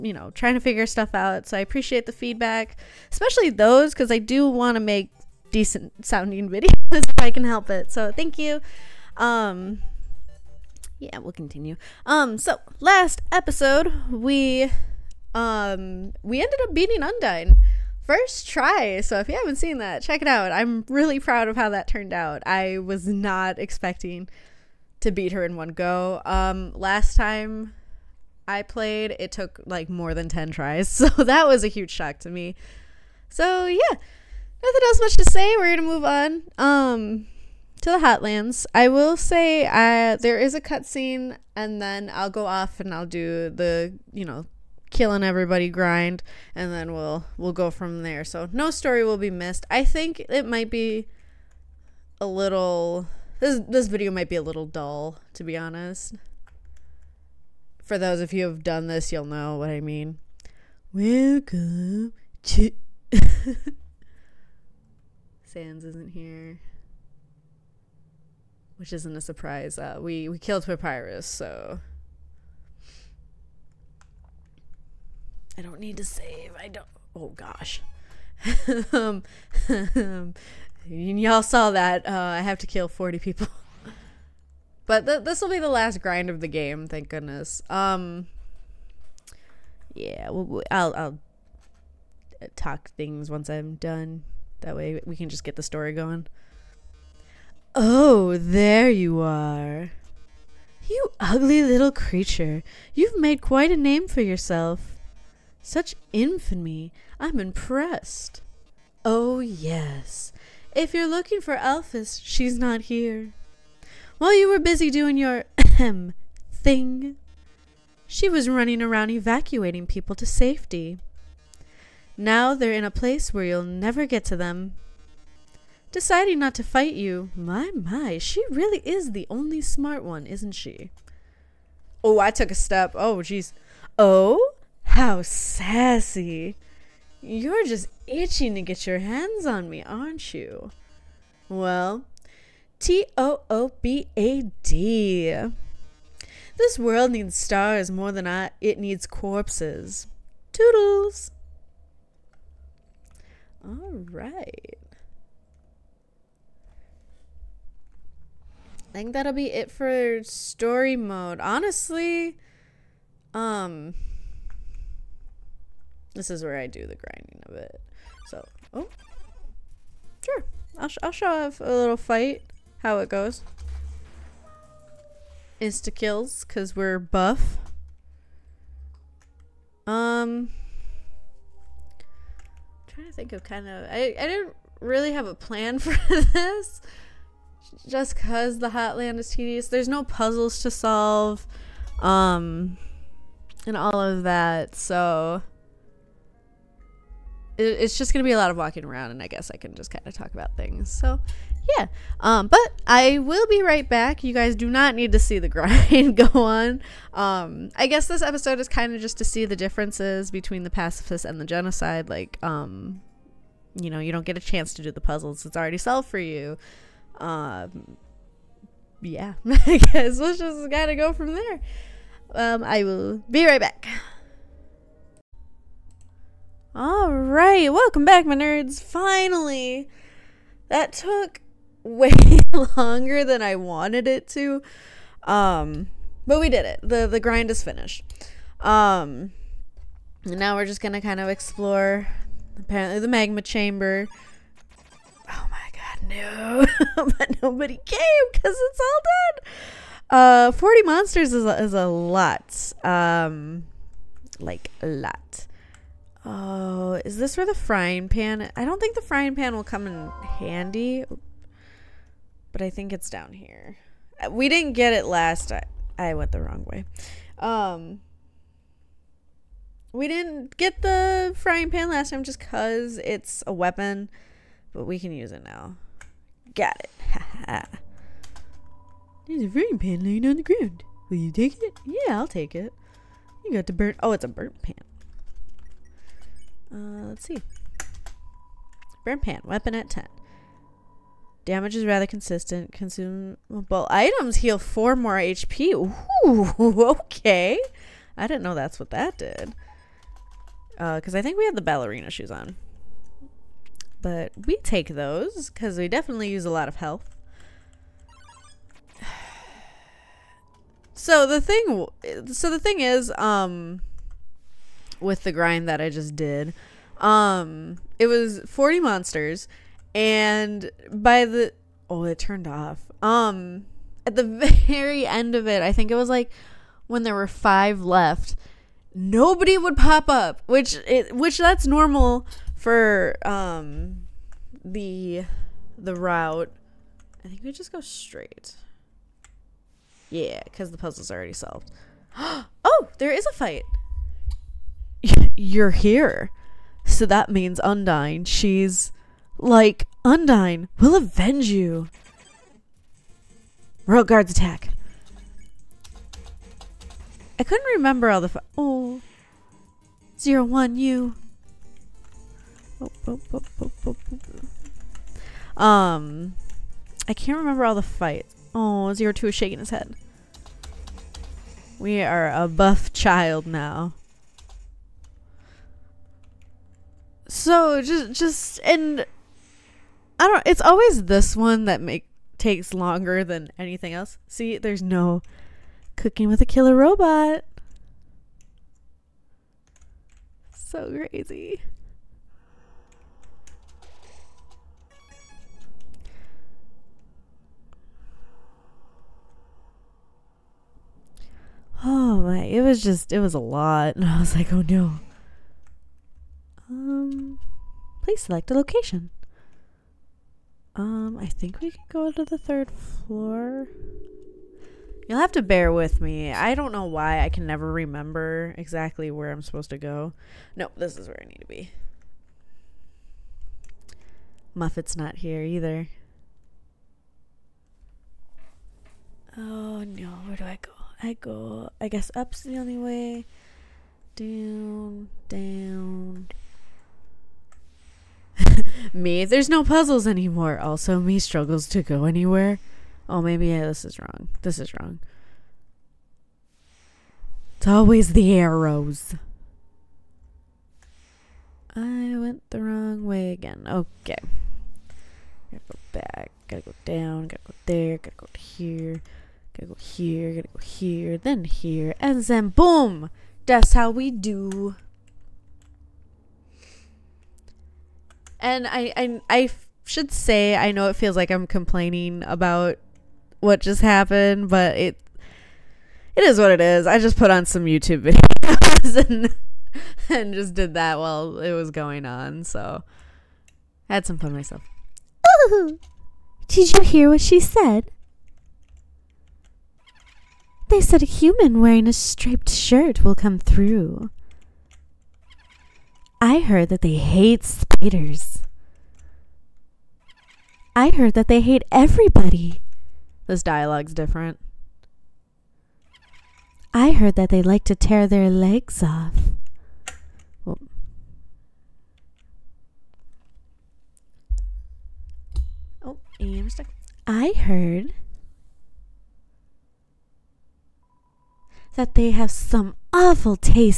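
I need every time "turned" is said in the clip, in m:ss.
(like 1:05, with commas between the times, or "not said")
0:21, 5:22.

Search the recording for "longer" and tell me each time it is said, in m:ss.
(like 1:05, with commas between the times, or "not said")
3:52, 6:22.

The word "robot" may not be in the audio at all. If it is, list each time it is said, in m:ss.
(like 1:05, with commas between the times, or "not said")
6:26.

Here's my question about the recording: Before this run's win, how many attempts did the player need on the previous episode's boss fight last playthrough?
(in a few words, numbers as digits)
more than 10.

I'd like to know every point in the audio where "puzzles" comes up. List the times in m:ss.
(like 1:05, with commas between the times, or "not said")
3:10, 3:35, 5:40, 7:19.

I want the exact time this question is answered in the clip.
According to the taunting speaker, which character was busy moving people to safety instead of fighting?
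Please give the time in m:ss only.
1:51.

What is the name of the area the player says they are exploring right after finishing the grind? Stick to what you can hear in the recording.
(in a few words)
magma chamber.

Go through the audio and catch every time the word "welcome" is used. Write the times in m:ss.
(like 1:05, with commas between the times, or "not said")
1:00, 3:47.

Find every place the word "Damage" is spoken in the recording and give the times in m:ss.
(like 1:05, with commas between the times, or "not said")
4:51.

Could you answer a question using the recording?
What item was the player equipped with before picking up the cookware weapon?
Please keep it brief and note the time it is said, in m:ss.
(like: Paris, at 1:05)
ballerina shoes, at 5:01.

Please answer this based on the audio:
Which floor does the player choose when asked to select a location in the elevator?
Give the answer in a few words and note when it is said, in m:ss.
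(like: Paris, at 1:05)
third floor, at 6:52.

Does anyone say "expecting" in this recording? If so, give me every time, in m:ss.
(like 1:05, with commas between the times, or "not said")
0:23.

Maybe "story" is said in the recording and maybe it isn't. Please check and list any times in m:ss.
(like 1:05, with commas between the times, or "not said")
0:48, 1:35, 2:40.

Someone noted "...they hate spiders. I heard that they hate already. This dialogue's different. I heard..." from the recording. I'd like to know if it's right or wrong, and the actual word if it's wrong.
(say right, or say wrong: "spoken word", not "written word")
wrong: "everybody", not "already".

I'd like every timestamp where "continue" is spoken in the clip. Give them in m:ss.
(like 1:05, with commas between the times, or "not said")
0:11.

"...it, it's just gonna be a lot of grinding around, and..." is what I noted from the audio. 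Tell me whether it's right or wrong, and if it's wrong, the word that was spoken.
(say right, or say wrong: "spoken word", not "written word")
wrong: "walking", not "grinding".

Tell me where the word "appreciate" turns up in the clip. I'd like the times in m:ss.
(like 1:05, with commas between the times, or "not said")
0:01.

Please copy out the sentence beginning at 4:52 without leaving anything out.
Consumable items heal 4 more HP.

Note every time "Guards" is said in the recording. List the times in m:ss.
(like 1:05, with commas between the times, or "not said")
5:54.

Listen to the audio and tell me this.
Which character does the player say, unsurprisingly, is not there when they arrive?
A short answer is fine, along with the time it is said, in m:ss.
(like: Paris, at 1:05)
Sans, at 1:05.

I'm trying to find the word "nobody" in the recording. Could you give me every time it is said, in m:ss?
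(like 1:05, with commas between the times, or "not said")
4:07, 5:28.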